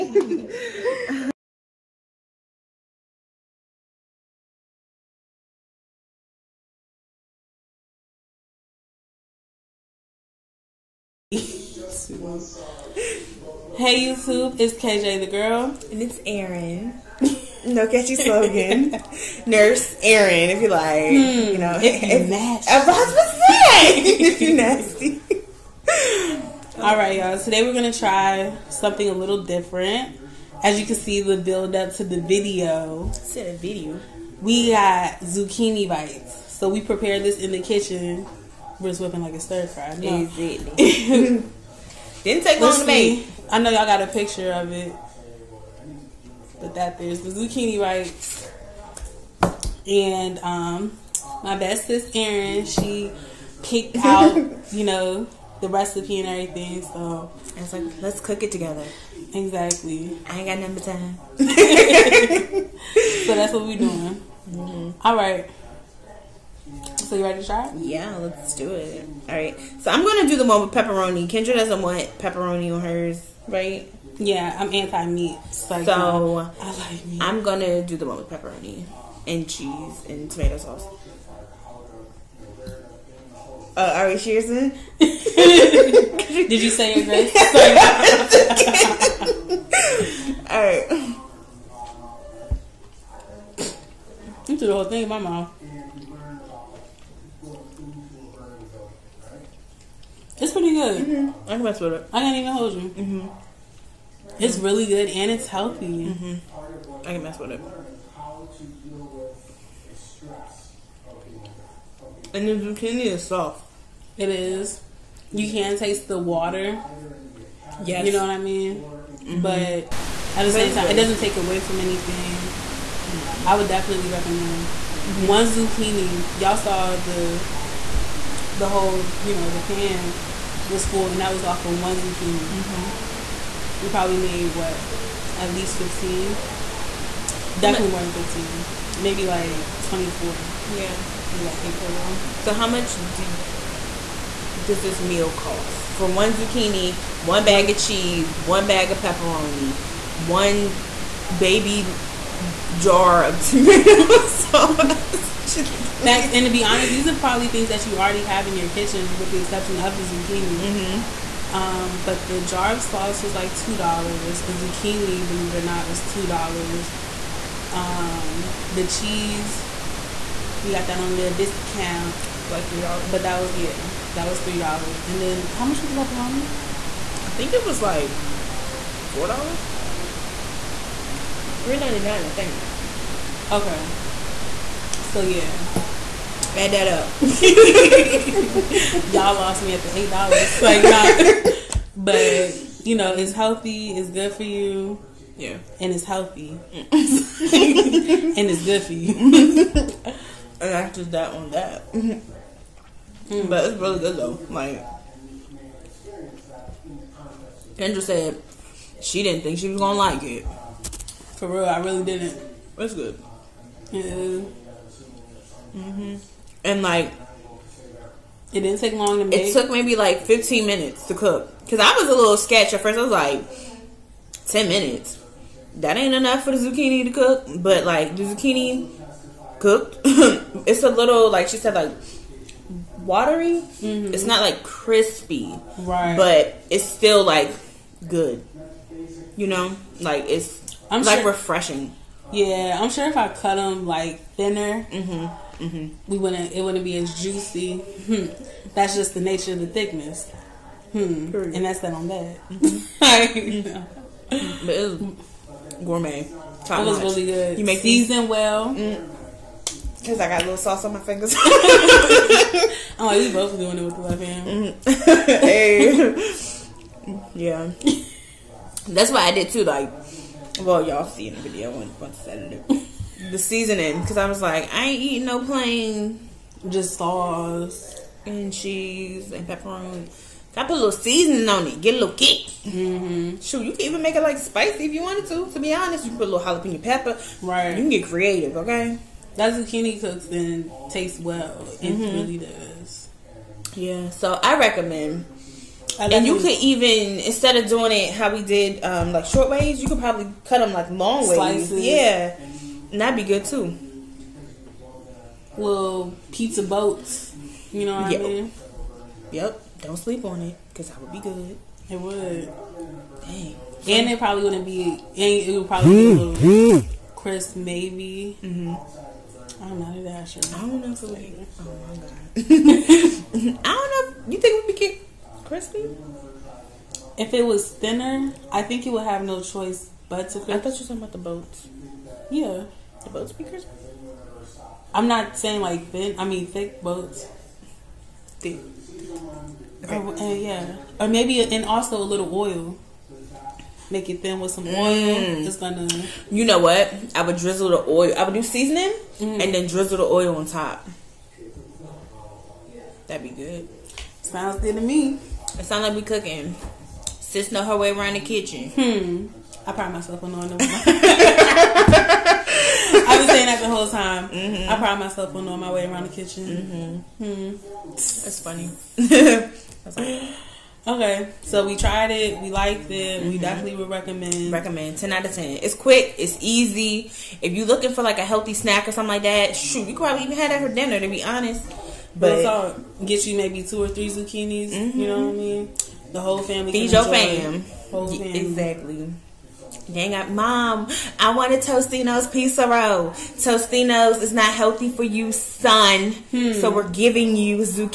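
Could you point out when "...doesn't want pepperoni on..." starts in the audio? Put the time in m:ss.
1:11.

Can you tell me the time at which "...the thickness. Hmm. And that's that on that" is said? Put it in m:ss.
4:09.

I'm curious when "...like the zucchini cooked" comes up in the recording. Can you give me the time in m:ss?
3:47.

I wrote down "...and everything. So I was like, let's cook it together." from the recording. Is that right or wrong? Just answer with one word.
right.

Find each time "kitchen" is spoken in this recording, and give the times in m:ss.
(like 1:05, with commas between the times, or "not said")
0:37, 2:38, 5:58, 6:06.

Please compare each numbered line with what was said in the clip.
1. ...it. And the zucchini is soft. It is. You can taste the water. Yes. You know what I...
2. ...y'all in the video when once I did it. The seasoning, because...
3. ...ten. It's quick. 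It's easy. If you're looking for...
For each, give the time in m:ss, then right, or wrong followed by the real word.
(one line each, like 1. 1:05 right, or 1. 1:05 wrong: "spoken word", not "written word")
1. 1:47 right
2. 4:30 right
3. 6:15 right.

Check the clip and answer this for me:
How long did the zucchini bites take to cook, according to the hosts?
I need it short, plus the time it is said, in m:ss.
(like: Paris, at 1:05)
15 minutes, at 3:40.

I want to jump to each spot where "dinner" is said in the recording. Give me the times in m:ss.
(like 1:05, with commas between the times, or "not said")
6:20.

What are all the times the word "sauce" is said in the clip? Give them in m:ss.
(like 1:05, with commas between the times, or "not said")
1:20, 2:34, 2:42, 4:20, 4:36.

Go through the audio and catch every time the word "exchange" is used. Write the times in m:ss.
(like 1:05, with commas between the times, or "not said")
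not said.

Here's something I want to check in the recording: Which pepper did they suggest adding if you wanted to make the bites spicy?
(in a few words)
jalapeno.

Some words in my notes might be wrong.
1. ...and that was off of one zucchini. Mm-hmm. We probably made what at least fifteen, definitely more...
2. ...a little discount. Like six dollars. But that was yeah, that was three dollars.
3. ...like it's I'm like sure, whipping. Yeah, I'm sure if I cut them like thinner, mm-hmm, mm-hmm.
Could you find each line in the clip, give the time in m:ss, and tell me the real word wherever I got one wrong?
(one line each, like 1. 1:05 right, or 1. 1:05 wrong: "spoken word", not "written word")
1. 2:11 right
2. 2:51 wrong: "three", not "six"
3. 3:59 wrong: "refreshing", not "whipping".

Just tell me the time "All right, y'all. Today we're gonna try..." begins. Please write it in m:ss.
0:26.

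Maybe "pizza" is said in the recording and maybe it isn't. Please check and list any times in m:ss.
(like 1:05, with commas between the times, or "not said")
5:06, 6:32.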